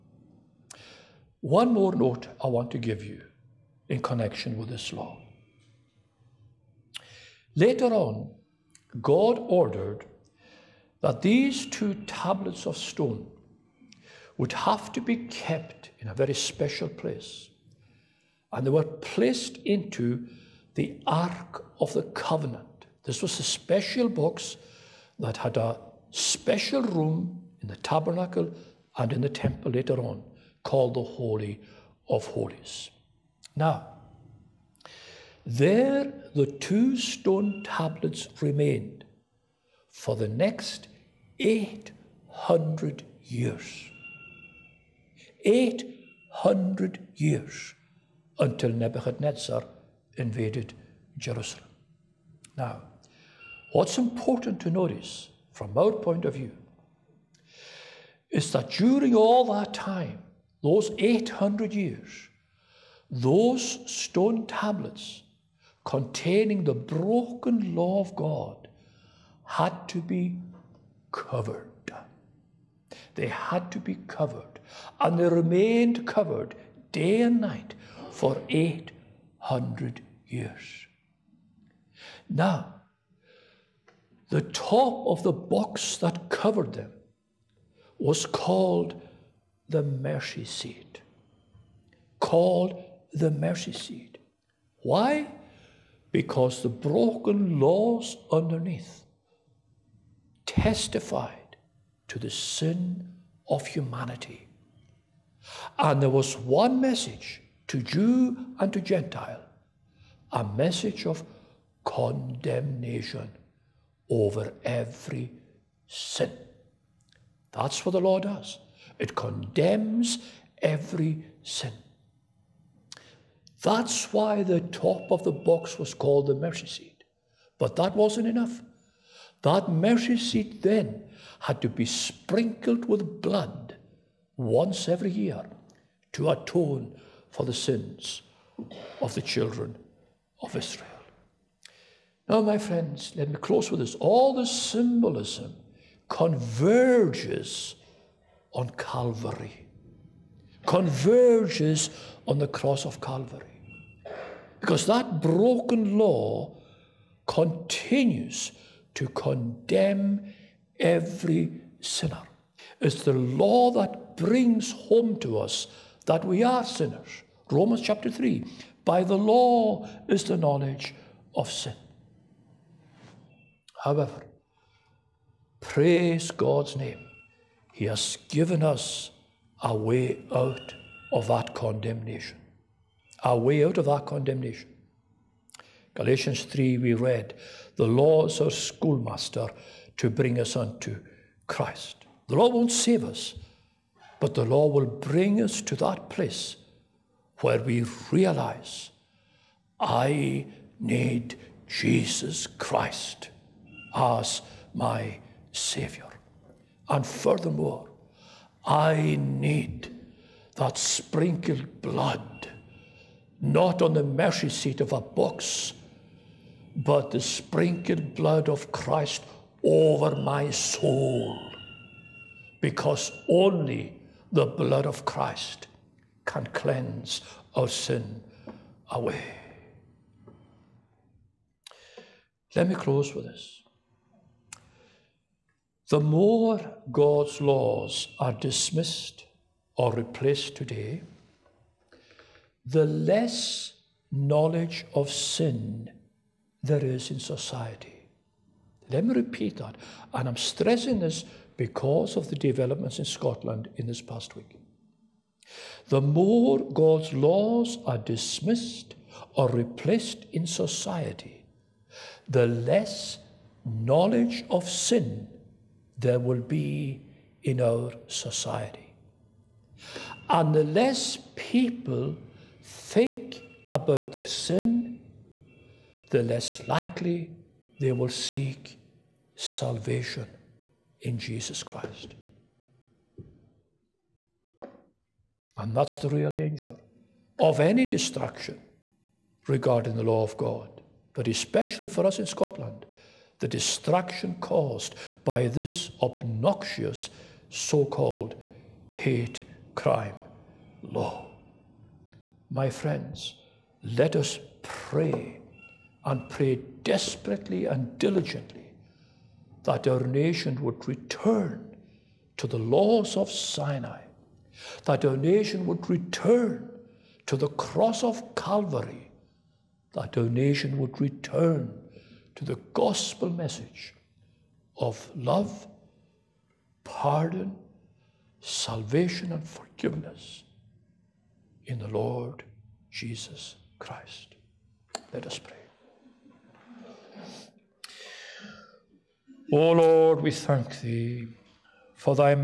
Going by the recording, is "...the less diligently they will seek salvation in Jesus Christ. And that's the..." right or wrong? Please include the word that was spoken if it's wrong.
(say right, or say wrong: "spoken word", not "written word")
wrong: "likely", not "diligently".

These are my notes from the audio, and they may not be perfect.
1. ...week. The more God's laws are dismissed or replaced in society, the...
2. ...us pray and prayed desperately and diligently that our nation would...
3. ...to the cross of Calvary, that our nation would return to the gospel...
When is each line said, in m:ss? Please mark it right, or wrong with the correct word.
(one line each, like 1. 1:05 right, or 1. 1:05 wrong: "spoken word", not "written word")
1. 4:14 right
2. 5:04 right
3. 5:17 right.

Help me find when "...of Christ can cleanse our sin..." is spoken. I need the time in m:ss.
3:44.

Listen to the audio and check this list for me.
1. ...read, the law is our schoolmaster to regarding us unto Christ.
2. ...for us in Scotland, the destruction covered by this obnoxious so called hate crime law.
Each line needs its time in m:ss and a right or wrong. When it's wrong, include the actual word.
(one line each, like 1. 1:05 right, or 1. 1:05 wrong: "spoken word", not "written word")
1. 3:06 wrong: "bring", not "regarding"
2. 4:51 wrong: "caused", not "covered".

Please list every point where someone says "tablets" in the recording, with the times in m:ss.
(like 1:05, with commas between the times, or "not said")
0:12, 0:37, 1:04.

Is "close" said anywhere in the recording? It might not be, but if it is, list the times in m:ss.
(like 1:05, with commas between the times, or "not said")
2:23, 3:52.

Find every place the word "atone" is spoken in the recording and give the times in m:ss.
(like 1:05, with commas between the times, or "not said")
2:16.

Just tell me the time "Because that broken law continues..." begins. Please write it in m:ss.
2:34.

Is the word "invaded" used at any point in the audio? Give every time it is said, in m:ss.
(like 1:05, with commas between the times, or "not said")
0:50.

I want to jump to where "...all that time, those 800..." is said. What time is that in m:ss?
0:59.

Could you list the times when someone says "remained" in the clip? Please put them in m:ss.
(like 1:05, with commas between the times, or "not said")
0:38, 1:15.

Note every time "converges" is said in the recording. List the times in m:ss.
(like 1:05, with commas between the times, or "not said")
2:26, 2:30.